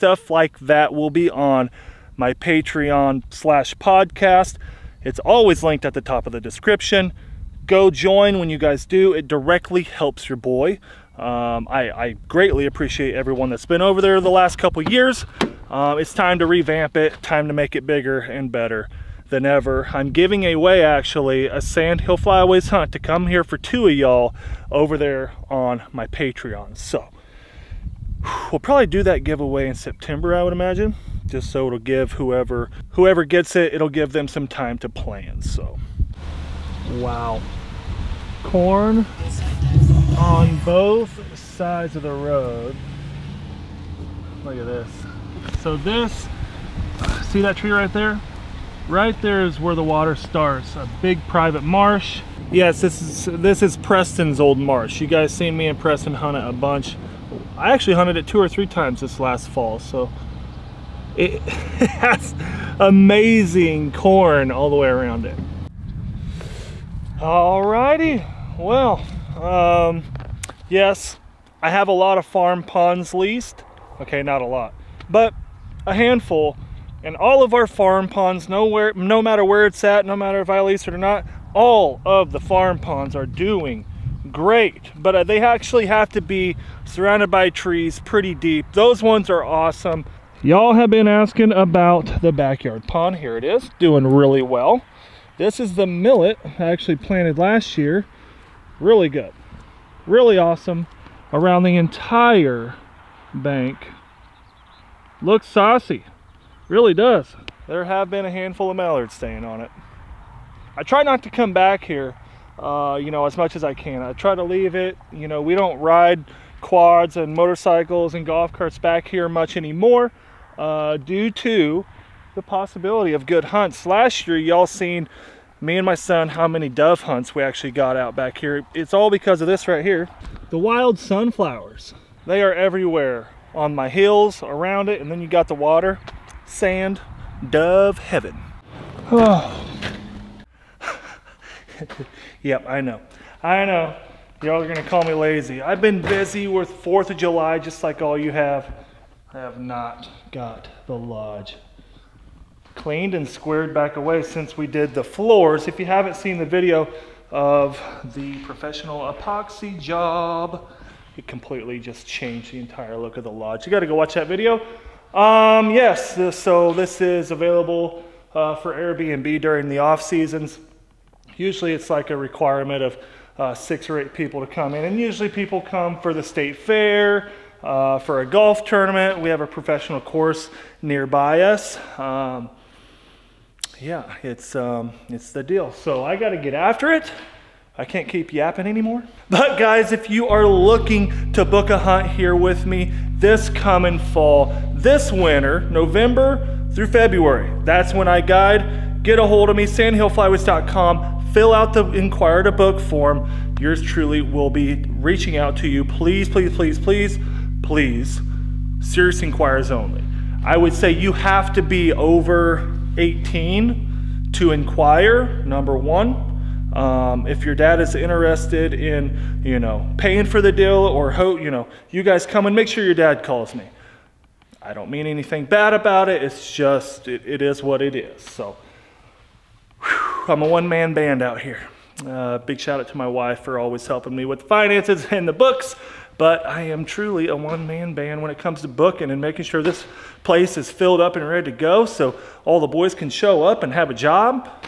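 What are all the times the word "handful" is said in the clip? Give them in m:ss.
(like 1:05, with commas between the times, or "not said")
1:15, 1:48.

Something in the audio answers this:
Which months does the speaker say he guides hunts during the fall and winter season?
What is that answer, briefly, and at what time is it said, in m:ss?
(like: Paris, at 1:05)
November through February, at 3:15.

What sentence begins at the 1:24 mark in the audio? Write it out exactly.
But uh, they actually have to be surrounded by trees pretty deep.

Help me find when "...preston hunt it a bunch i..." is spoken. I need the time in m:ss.
0:55.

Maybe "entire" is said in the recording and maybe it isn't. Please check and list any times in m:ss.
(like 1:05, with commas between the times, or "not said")
1:41, 2:42.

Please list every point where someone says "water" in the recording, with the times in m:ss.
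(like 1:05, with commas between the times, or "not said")
0:49, 2:15.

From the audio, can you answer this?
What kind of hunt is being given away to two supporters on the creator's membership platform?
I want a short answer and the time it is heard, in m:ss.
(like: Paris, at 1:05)
Sandhill Flyways hunt, at 0:21.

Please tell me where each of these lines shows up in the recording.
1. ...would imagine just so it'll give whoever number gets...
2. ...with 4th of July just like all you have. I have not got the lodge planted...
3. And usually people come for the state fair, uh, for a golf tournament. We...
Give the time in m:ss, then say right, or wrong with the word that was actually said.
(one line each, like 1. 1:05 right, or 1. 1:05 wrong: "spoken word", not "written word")
1. 0:30 wrong: "whoever", not "number"
2. 2:26 wrong: "cleaned", not "planted"
3. 2:54 right.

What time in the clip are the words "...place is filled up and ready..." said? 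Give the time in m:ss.
4:00.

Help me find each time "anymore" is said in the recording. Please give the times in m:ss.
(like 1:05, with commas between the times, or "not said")
1:59, 3:08.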